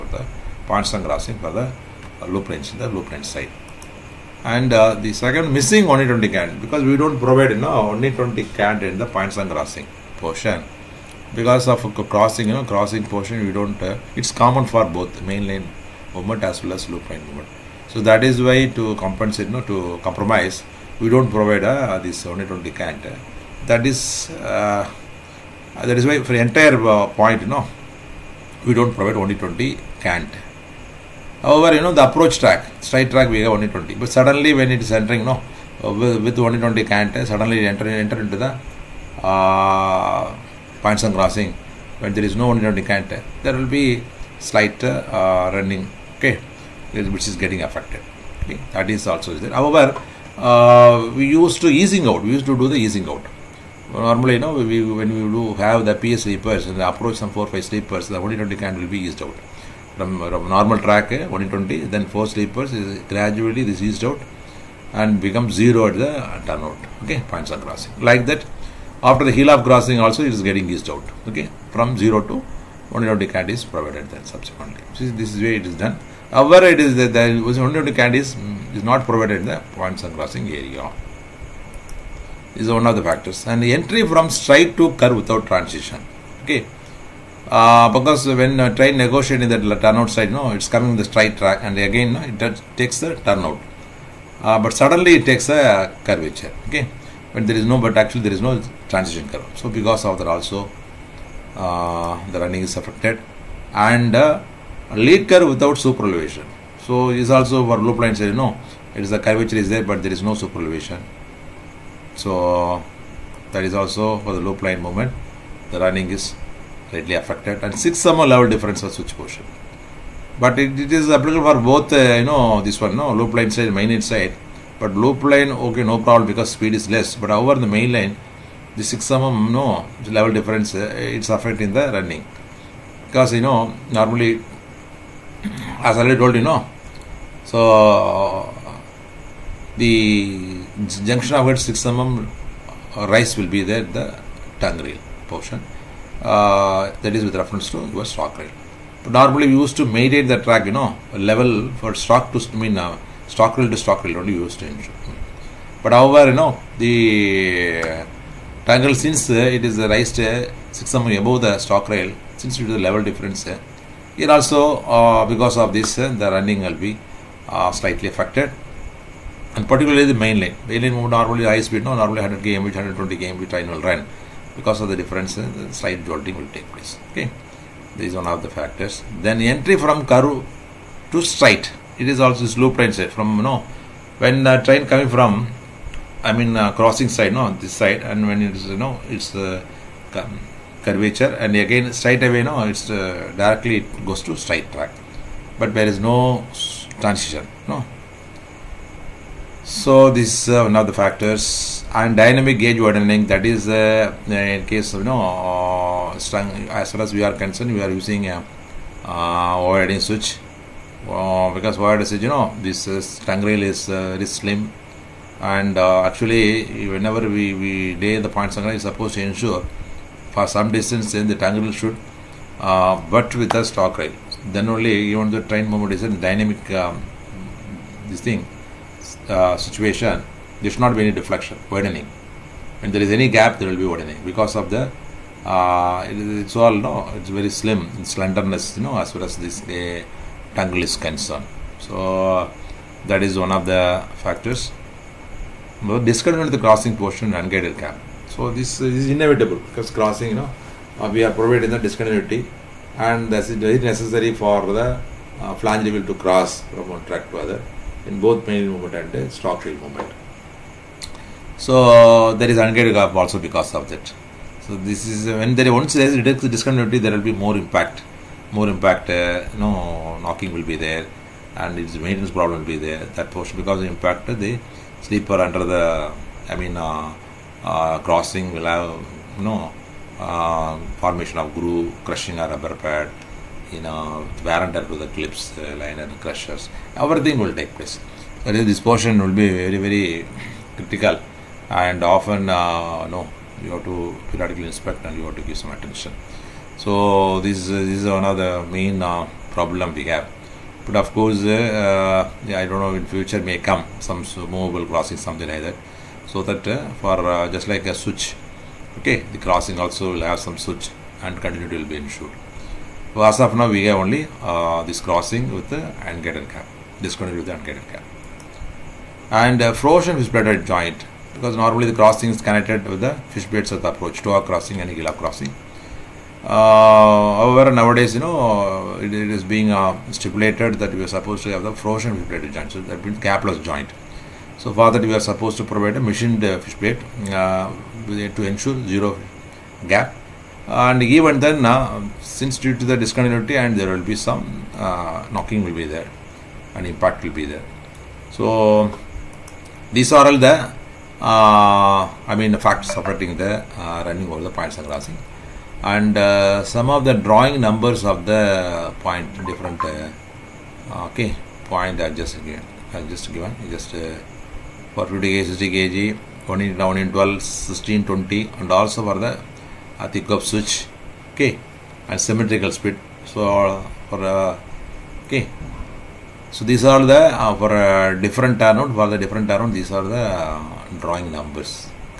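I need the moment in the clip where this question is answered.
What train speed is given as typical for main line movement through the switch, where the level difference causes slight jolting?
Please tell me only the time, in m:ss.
2:52.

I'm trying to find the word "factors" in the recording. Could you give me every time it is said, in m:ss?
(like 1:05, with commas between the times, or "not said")
1:23, 2:58, 3:20, 4:04, 5:52.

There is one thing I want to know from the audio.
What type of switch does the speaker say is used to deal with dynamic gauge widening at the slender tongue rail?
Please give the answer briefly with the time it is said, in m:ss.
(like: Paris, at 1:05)
widening switch, at 3:29.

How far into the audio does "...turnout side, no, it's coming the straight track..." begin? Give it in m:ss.
1:29.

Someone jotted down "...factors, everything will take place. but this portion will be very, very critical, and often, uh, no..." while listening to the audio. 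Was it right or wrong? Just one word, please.
wrong.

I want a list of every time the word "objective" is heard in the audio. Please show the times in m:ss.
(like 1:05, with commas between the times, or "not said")
not said.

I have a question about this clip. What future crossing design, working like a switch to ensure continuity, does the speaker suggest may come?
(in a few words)
movable crossing.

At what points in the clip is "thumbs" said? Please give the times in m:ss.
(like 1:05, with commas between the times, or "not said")
not said.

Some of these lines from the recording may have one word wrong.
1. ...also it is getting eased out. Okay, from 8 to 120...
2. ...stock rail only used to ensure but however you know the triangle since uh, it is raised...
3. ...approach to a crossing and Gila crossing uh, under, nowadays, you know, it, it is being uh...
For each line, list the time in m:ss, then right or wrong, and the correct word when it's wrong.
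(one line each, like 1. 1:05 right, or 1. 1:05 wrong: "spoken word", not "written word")
1. 1:09 wrong: "0", not "8"
2. 2:33 right
3. 5:23 wrong: "however", not "under".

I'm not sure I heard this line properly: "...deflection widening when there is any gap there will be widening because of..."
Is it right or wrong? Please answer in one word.
right.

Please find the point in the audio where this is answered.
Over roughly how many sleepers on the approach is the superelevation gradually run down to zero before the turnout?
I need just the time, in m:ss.
0:57.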